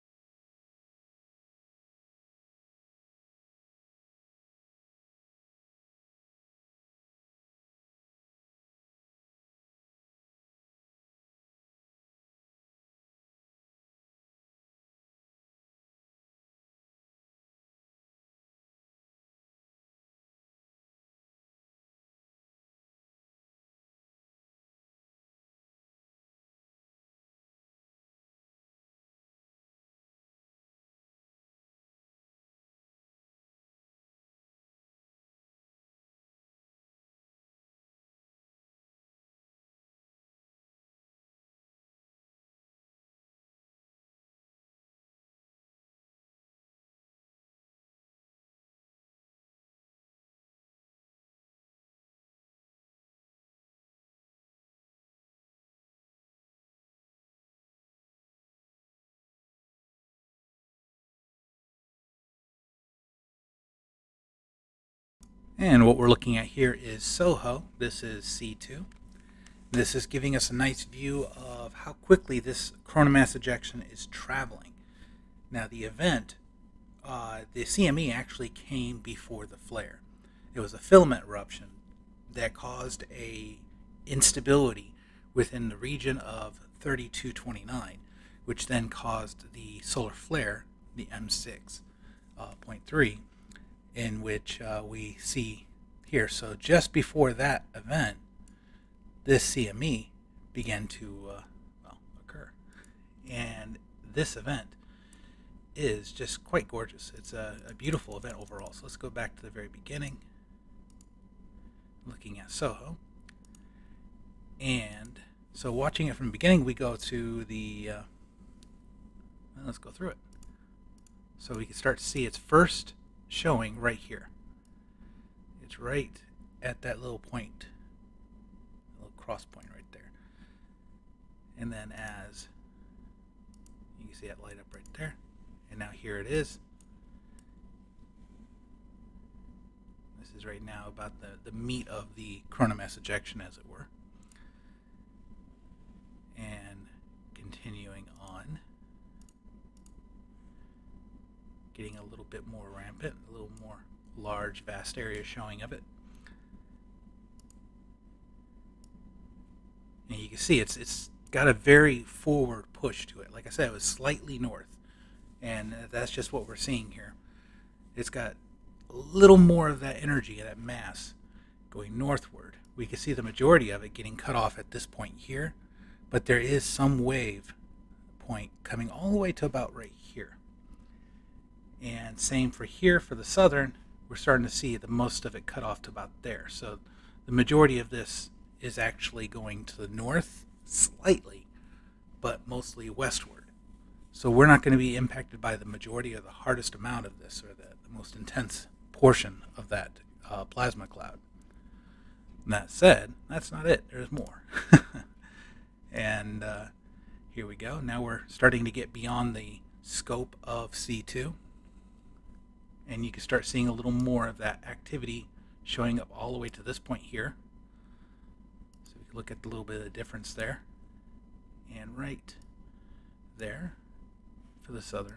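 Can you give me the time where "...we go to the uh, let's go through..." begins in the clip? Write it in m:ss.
1:56.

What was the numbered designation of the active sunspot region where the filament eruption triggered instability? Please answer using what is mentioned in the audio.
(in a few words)
3229.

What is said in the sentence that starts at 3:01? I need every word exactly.
And same for here for the southern, we're starting to see the most of it cut off to about there.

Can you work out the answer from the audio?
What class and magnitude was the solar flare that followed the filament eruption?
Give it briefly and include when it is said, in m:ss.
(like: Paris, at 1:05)
M6.3, at 1:31.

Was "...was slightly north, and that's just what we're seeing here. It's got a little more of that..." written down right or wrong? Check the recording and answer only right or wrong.
right.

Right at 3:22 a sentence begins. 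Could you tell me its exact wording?
And that said, that's not it.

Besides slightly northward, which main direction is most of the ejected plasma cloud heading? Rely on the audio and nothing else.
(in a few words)
Westward.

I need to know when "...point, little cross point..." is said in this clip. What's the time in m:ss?
2:07.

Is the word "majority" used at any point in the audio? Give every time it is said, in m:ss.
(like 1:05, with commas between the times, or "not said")
2:53, 3:07, 3:15.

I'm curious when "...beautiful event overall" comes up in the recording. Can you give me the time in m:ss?
1:47.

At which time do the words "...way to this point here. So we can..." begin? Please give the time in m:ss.
3:36.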